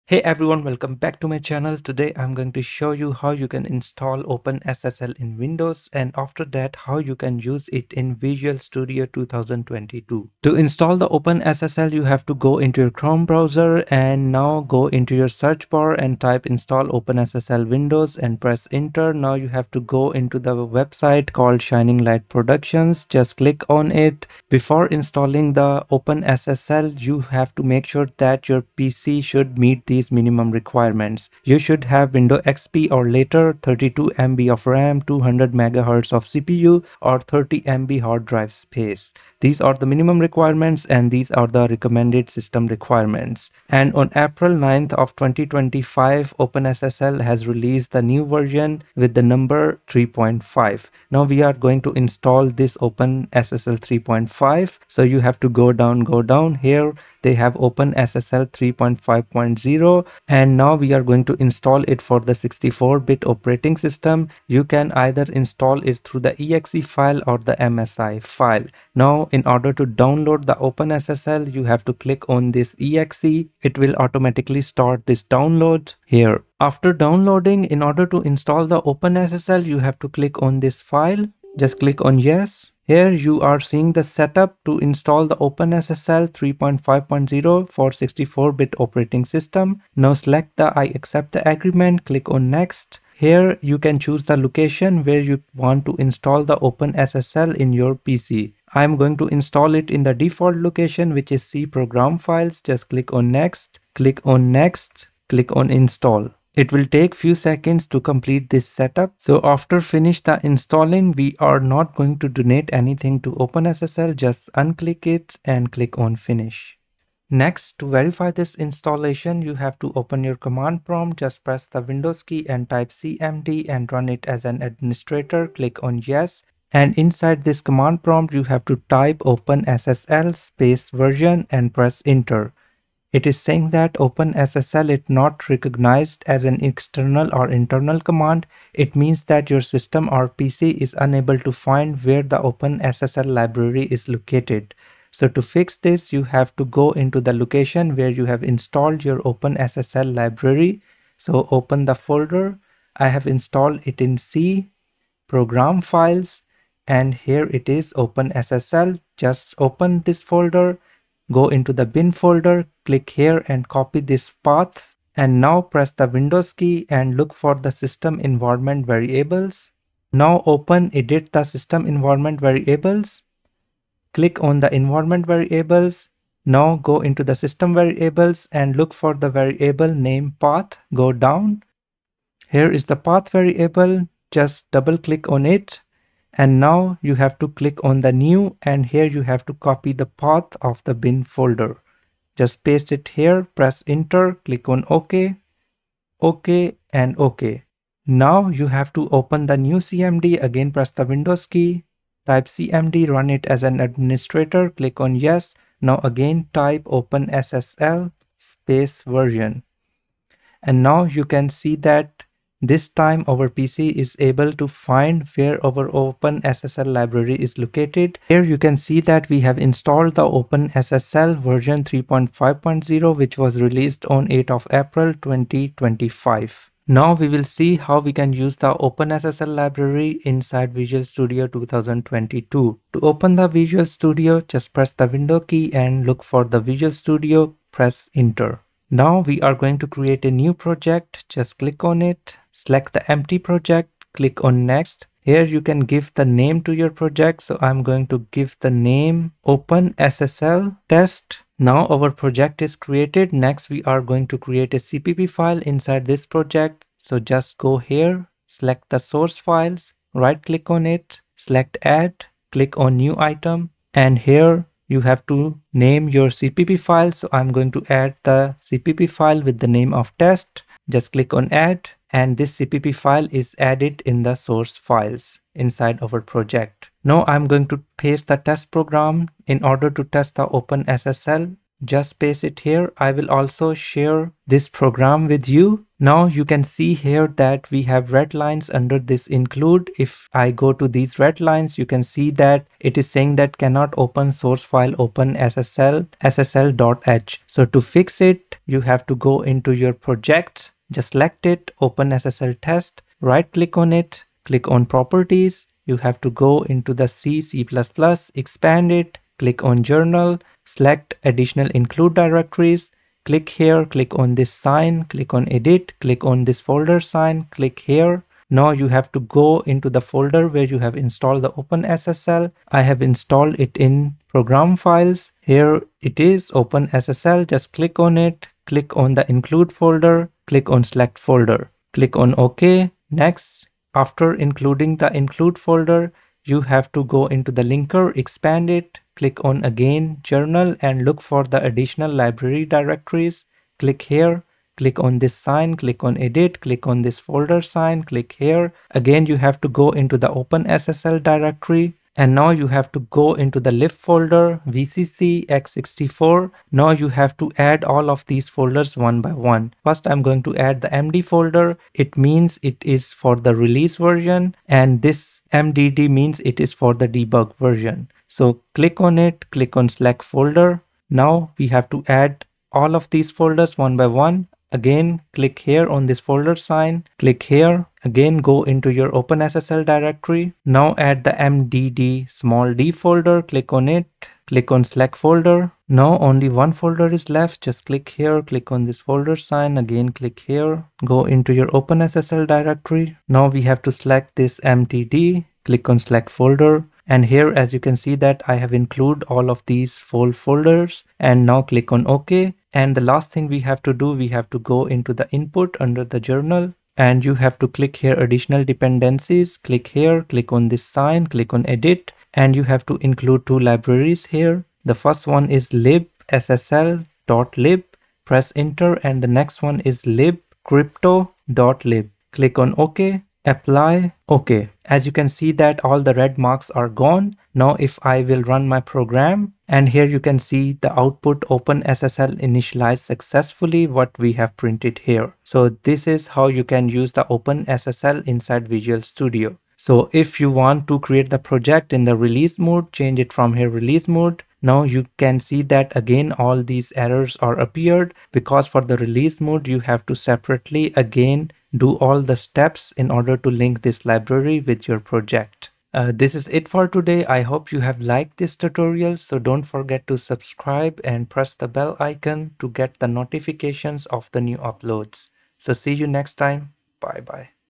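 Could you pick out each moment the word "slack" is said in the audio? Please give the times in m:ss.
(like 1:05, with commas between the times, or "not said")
6:09, 6:24, 6:35.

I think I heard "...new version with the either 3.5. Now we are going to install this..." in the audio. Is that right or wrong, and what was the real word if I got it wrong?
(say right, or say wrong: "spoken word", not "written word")
wrong: "number", not "either".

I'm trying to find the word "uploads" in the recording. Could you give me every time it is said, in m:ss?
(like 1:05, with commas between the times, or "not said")
7:44.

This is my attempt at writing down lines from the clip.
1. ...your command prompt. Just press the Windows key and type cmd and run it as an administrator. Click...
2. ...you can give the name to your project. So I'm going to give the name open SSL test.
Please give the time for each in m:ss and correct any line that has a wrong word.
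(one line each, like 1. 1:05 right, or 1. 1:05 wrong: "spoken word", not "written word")
1. 2:00 right
2. 4:05 right.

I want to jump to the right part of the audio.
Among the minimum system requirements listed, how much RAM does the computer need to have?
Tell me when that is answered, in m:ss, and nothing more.
0:33.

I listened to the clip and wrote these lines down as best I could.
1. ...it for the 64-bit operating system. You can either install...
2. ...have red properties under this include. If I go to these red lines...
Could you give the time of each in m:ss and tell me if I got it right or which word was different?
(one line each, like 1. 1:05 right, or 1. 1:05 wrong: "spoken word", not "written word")
1. 1:01 right
2. 4:47 wrong: "lines", not "properties".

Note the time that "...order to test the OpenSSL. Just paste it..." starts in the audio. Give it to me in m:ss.
4:39.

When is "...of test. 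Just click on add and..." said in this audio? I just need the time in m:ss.
4:29.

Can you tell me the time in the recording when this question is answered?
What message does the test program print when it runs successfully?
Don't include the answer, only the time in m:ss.
7:11.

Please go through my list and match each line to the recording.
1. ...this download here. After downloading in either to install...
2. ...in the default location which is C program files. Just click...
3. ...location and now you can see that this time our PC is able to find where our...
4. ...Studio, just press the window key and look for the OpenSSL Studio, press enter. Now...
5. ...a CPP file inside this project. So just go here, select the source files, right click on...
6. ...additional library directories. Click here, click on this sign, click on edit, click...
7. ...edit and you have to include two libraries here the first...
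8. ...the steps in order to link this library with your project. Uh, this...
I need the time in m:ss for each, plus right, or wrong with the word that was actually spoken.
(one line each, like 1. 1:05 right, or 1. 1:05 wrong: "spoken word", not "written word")
1. 1:15 wrong: "order", not "either"
2. 1:39 right
3. 3:29 wrong: "version", not "location"
4. 3:53 wrong: "Visual", not "OpenSSL"
5. 4:14 right
6. 5:41 right
7. 6:51 right
8. 7:32 right.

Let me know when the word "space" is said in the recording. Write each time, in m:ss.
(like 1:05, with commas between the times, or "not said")
0:38, 2:10, 3:28.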